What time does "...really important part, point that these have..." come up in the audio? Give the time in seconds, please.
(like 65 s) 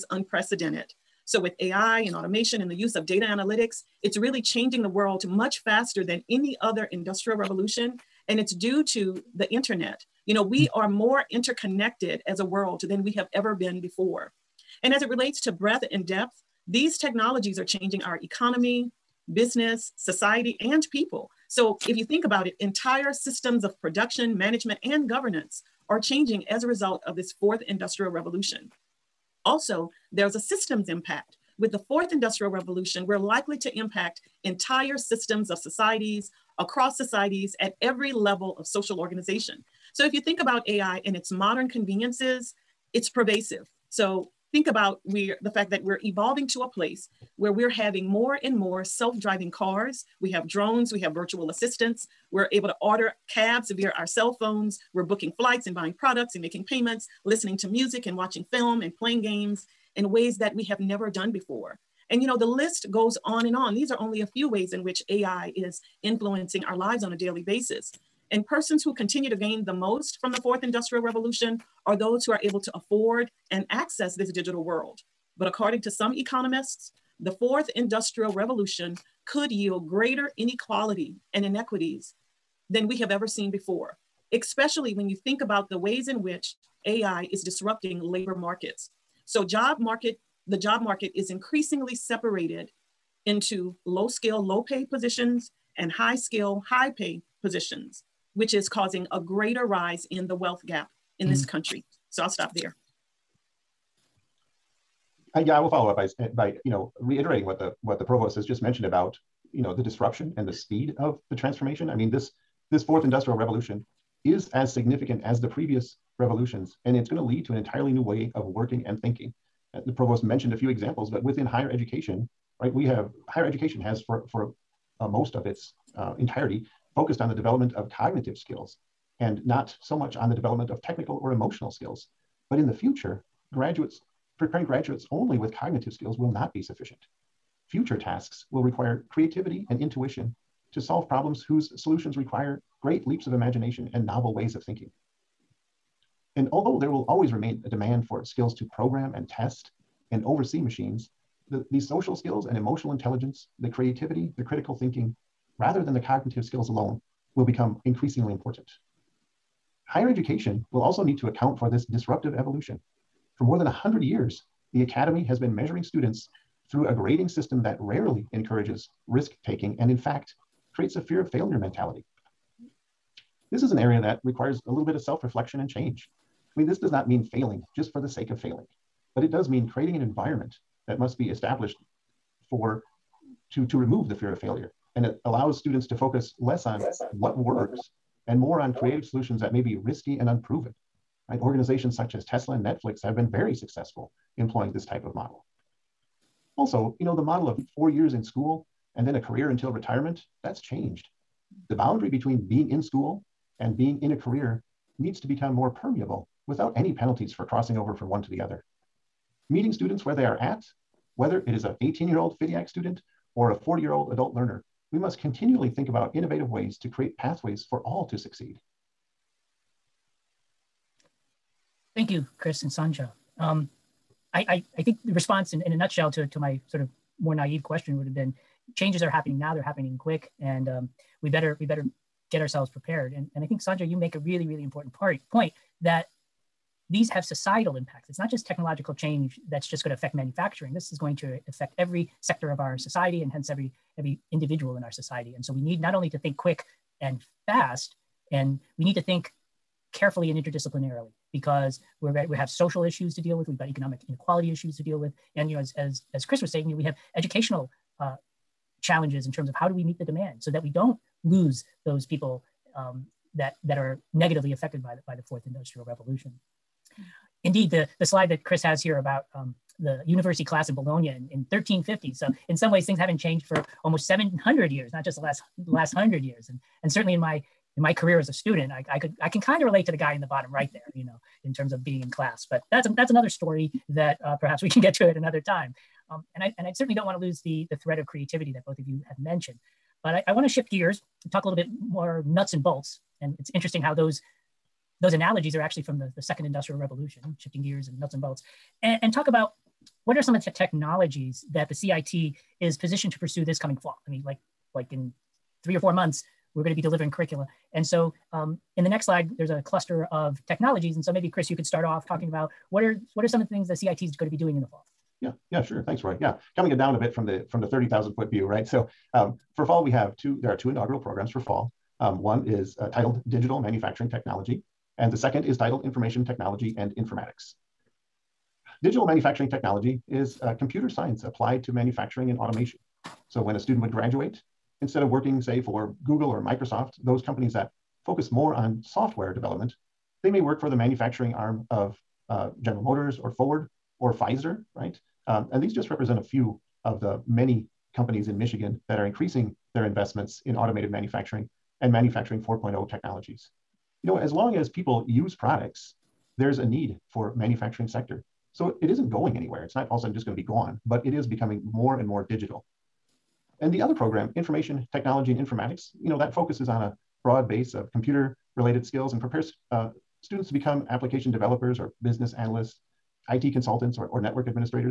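234 s.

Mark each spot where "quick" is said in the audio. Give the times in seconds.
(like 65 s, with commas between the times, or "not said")
229 s, 246 s.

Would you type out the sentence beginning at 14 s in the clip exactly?
And as it relates to breadth and depth, these technologies are changing our economy, business, society, and people.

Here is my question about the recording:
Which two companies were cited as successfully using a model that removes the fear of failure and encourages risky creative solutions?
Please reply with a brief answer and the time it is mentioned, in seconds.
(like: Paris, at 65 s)
Tesla and Netflix, at 192 s.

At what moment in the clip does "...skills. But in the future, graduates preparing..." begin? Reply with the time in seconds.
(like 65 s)
131 s.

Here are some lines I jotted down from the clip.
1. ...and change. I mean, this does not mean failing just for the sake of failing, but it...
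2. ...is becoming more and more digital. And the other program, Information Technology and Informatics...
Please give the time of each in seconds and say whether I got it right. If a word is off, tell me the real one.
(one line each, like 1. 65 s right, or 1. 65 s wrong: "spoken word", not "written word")
1. 175 s right
2. 361 s right.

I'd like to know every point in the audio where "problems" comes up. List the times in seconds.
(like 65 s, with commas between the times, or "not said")
141 s.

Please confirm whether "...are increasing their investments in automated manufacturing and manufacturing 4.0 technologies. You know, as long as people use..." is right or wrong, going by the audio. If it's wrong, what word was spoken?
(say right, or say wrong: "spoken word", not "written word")
right.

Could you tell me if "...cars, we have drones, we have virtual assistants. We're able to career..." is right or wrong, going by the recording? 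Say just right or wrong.
wrong.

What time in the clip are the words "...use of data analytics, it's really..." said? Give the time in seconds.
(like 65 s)
2 s.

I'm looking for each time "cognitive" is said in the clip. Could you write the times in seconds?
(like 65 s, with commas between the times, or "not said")
127 s, 135 s, 155 s.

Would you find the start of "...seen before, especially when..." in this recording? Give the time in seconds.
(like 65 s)
83 s.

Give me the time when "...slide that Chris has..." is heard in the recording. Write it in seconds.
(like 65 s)
268 s.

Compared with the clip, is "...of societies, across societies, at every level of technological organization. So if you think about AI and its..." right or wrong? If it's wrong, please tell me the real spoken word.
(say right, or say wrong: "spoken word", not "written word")
wrong: "social", not "technological".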